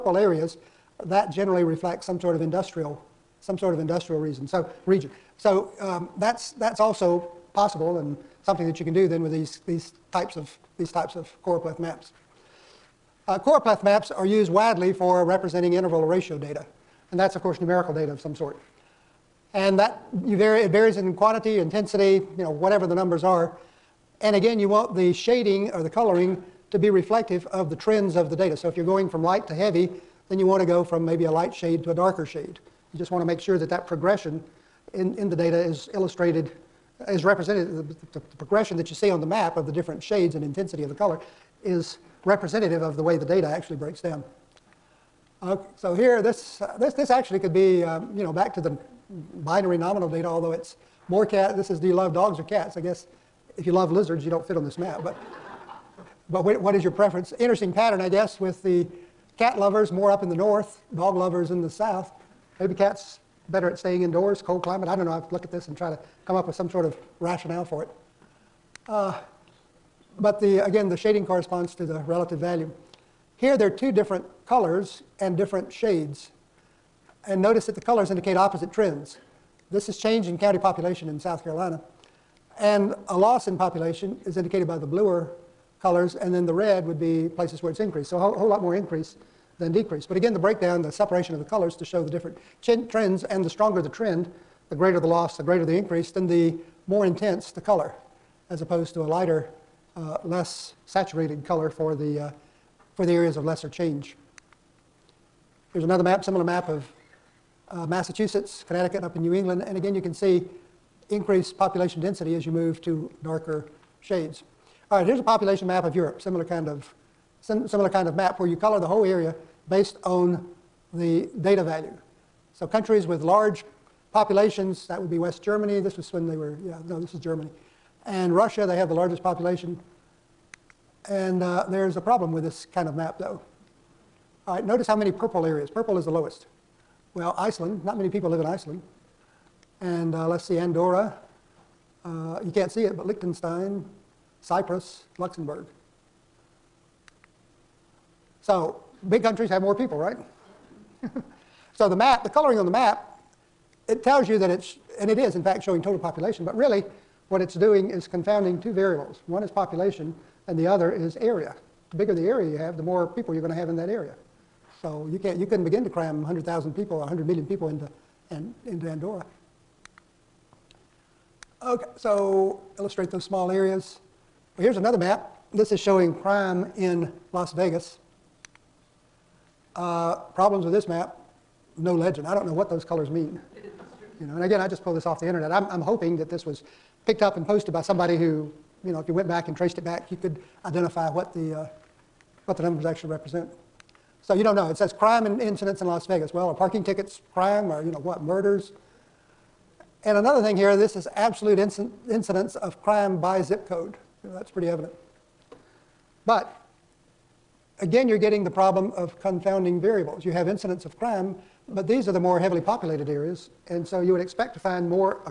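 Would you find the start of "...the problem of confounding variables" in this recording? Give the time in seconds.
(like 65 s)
208 s.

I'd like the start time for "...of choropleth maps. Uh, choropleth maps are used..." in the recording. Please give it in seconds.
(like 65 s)
11 s.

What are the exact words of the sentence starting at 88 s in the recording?
So a whole, whole lot more increase than decrease.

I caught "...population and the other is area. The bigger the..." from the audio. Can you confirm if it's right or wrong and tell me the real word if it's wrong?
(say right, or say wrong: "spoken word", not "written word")
right.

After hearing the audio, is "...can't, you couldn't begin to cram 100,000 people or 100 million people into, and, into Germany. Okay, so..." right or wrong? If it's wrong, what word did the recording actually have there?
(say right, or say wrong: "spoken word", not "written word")
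wrong: "Andorra", not "Germany".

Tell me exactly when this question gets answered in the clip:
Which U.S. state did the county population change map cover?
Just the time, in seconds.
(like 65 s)
81 s.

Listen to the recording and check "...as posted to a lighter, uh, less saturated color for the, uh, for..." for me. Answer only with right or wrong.
wrong.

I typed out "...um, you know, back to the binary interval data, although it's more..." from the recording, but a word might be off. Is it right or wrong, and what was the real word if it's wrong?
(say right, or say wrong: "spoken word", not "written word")
wrong: "nominal", not "interval".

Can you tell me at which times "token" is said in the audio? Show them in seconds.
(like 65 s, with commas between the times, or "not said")
not said.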